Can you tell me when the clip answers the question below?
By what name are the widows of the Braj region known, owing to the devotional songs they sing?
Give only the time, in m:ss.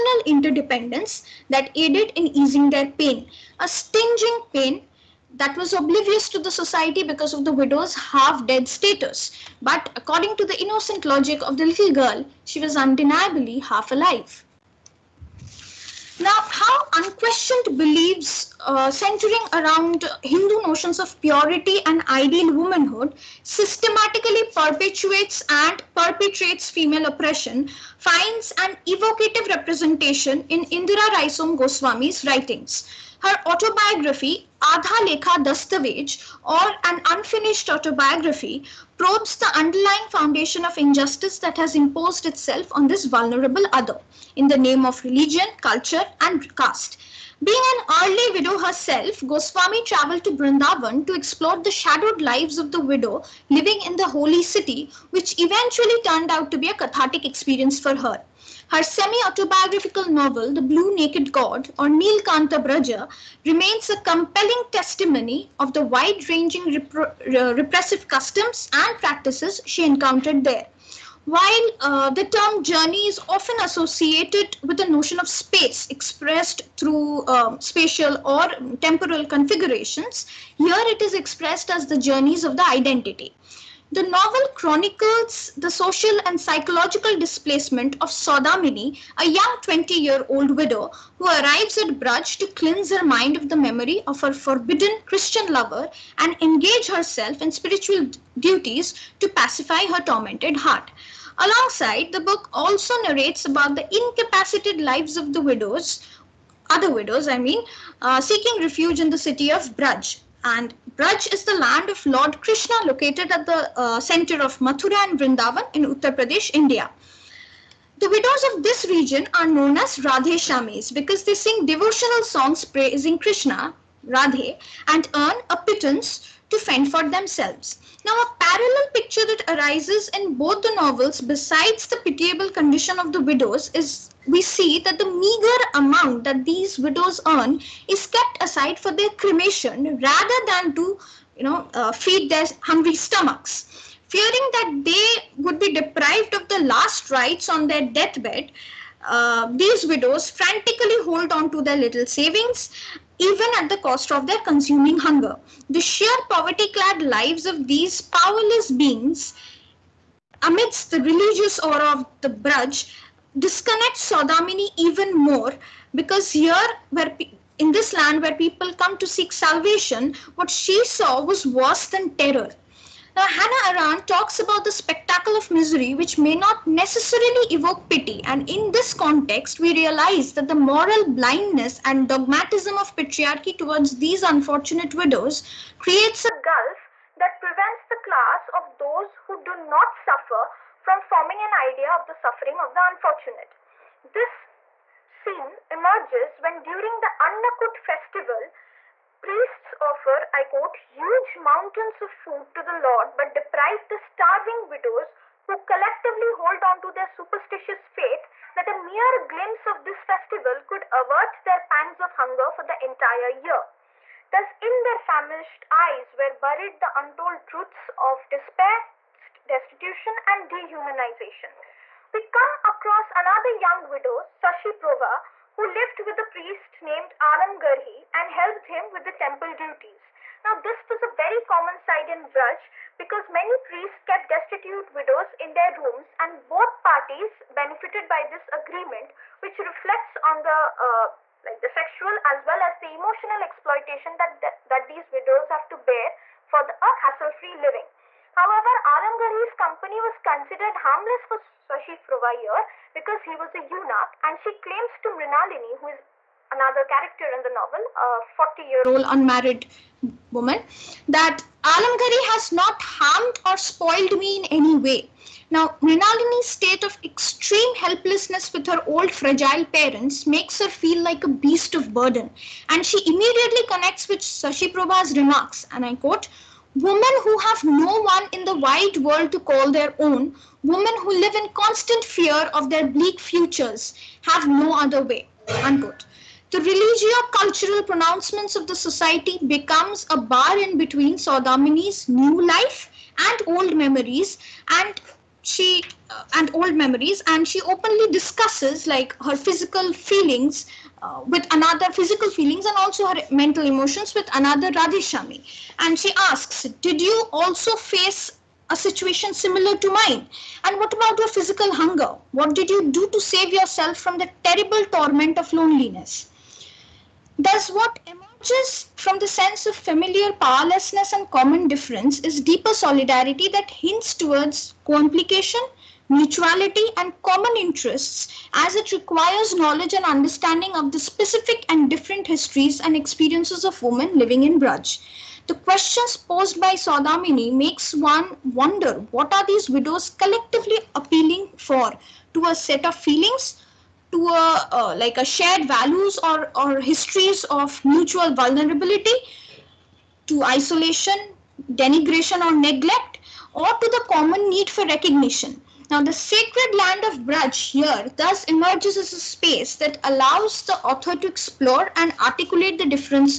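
1:59.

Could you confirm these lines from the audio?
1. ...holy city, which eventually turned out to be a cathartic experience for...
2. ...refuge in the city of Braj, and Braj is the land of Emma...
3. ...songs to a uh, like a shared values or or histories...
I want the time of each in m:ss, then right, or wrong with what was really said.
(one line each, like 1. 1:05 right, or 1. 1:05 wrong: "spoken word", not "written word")
1. 0:54 right
2. 1:48 wrong: "Lord", not "Emma"
3. 5:42 wrong: "feelings", not "songs".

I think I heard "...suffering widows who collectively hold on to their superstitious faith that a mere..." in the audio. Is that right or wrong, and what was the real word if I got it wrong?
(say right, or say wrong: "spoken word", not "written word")
wrong: "starving", not "suffering".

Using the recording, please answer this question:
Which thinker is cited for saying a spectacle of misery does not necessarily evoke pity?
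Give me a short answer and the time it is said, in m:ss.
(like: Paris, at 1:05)
Hannah Arendt, at 2:53.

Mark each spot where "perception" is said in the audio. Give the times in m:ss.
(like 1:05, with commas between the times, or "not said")
not said.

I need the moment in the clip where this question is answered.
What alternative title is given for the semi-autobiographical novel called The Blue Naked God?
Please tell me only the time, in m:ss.
1:01.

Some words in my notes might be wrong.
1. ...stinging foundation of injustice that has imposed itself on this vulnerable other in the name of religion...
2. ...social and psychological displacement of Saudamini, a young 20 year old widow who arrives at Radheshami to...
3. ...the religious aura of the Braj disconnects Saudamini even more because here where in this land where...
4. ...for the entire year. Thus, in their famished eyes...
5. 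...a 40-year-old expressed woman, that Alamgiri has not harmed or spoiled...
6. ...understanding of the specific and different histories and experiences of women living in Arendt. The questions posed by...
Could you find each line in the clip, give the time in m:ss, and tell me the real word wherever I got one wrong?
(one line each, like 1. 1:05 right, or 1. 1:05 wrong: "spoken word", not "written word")
1. 0:39 wrong: "underlying", not "stinging"
2. 1:25 wrong: "Braj", not "Radheshami"
3. 2:40 right
4. 3:32 right
5. 4:17 wrong: "unmarried", not "expressed"
6. 5:30 wrong: "Braj", not "Arendt".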